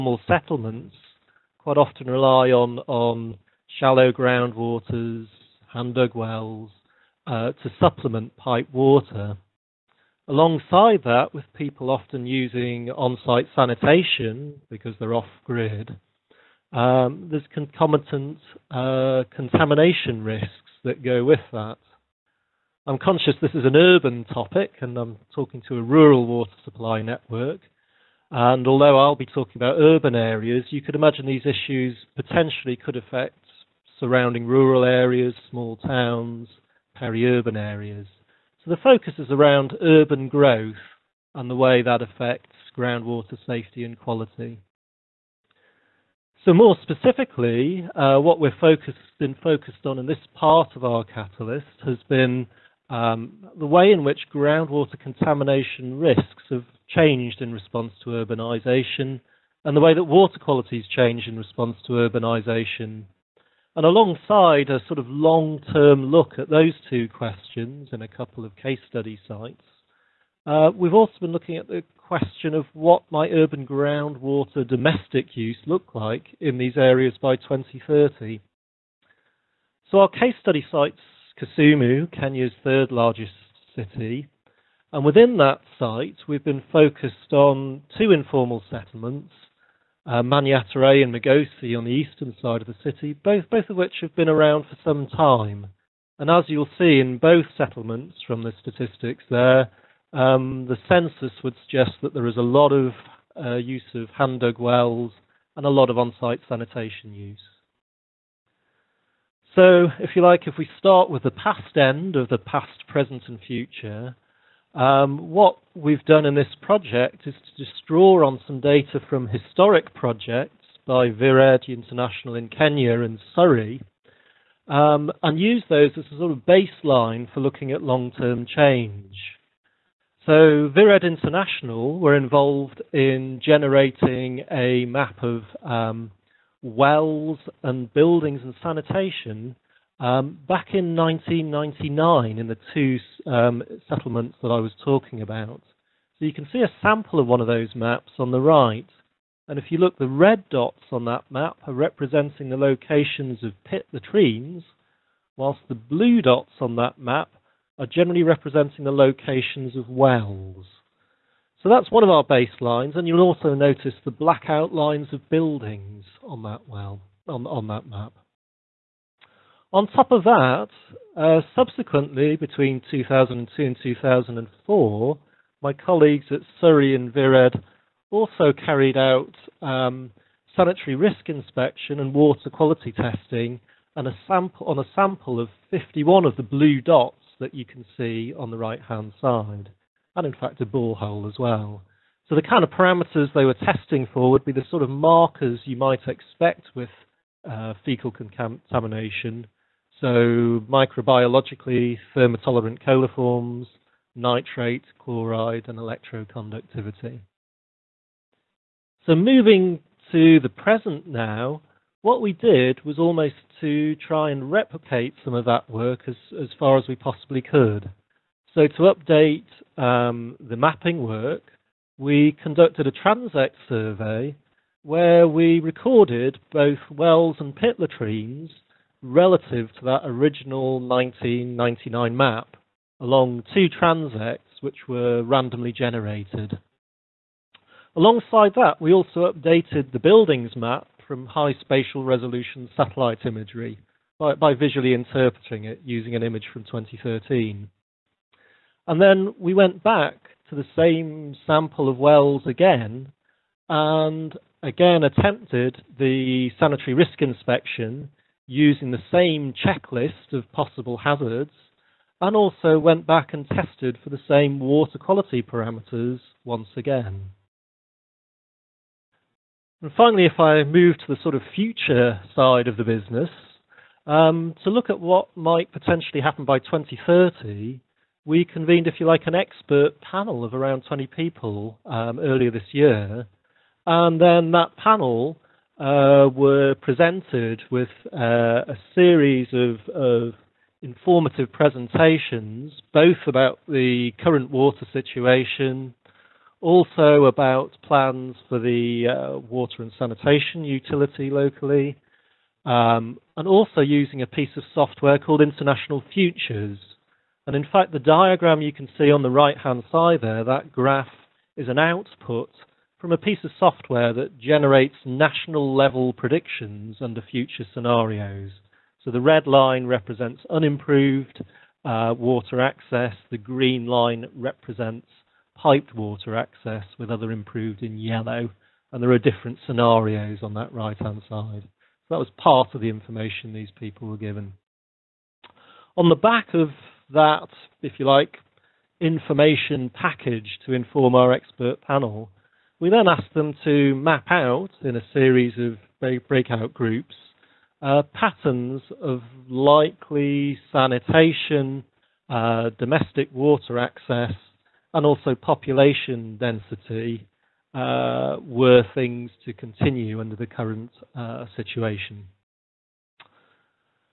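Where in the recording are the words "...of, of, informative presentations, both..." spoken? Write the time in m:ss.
4:49.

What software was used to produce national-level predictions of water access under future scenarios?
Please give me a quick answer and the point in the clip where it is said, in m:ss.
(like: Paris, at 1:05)
International Futures, at 5:05.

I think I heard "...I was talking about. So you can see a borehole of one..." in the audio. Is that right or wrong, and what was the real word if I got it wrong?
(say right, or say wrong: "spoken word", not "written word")
wrong: "sample", not "borehole".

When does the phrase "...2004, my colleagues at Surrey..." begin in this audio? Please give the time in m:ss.
2:53.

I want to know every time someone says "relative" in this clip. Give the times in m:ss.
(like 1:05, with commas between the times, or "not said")
3:49.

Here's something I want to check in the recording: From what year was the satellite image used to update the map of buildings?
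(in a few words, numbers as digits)
2013.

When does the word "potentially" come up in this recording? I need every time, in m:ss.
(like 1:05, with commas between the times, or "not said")
0:32, 4:35.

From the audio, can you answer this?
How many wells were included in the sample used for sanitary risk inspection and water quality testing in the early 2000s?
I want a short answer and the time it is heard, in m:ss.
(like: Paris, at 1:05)
51, at 3:05.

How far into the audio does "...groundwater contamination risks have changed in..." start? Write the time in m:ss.
0:54.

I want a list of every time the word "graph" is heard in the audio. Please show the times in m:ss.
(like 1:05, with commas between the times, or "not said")
5:10.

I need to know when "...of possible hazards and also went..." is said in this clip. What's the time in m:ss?
4:20.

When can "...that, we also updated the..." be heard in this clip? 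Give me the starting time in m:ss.
3:58.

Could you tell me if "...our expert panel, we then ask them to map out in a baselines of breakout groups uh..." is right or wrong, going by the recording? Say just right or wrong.
wrong.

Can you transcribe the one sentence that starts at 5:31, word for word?
So that was part of the information these people were given.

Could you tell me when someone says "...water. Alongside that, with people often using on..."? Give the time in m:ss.
0:08.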